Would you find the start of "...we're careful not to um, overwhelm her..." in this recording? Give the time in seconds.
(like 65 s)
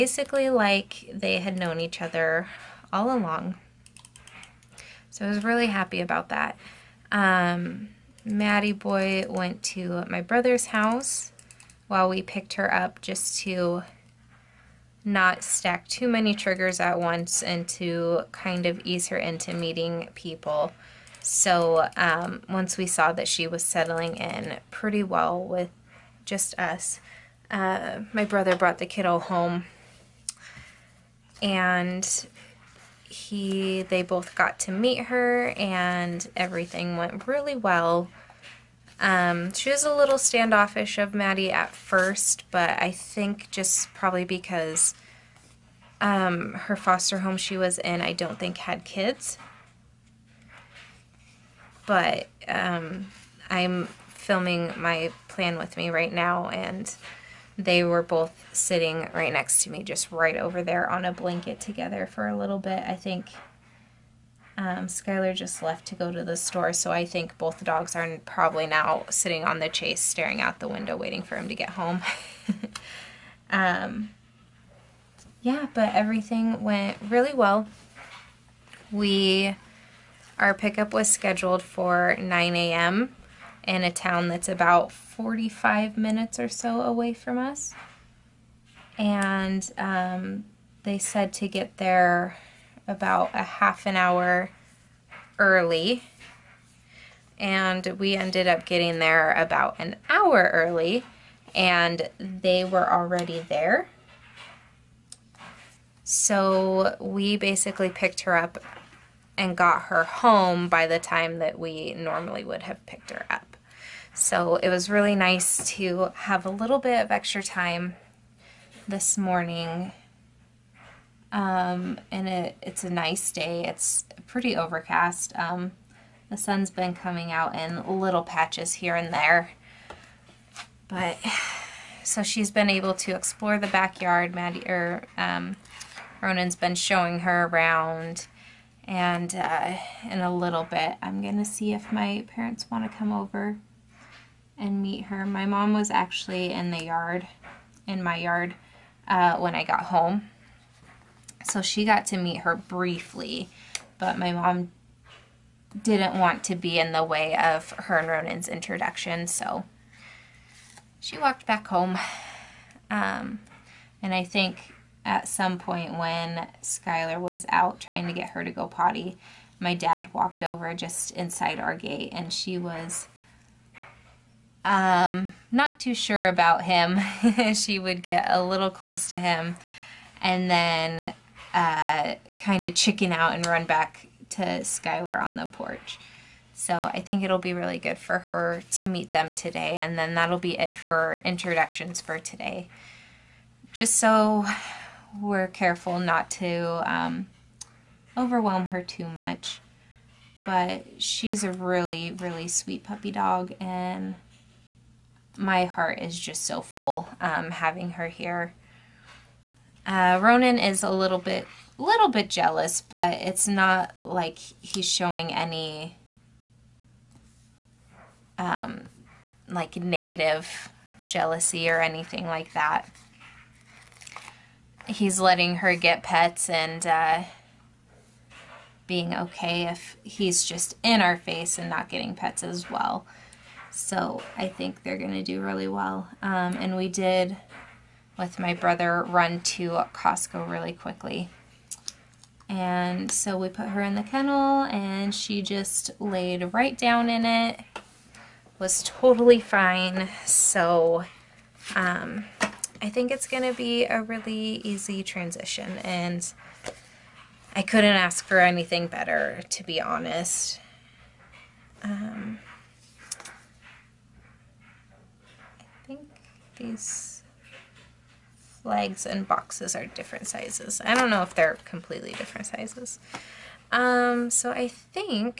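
195 s.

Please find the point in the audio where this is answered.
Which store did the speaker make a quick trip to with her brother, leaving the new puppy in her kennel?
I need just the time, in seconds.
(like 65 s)
239 s.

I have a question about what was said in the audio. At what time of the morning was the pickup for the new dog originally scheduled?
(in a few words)
9 a.m.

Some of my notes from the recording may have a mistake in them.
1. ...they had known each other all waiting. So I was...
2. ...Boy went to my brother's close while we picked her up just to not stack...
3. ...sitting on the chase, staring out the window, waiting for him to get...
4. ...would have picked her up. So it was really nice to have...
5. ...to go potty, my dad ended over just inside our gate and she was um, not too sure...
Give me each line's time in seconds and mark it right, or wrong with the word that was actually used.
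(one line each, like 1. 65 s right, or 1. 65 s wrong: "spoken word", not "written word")
1. 1 s wrong: "along", not "waiting"
2. 8 s wrong: "house", not "close"
3. 69 s right
4. 112 s right
5. 168 s wrong: "walked", not "ended".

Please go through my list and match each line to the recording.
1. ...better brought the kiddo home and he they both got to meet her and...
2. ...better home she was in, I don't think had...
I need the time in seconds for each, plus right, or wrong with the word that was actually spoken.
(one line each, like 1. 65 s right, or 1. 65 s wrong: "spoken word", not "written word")
1. 28 s wrong: "brother", not "better"
2. 46 s wrong: "foster", not "better".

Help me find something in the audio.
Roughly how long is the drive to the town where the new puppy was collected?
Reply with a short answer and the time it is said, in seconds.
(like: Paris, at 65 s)
45 minutes, at 85 s.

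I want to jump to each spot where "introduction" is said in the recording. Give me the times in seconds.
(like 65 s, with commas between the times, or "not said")
158 s, 191 s.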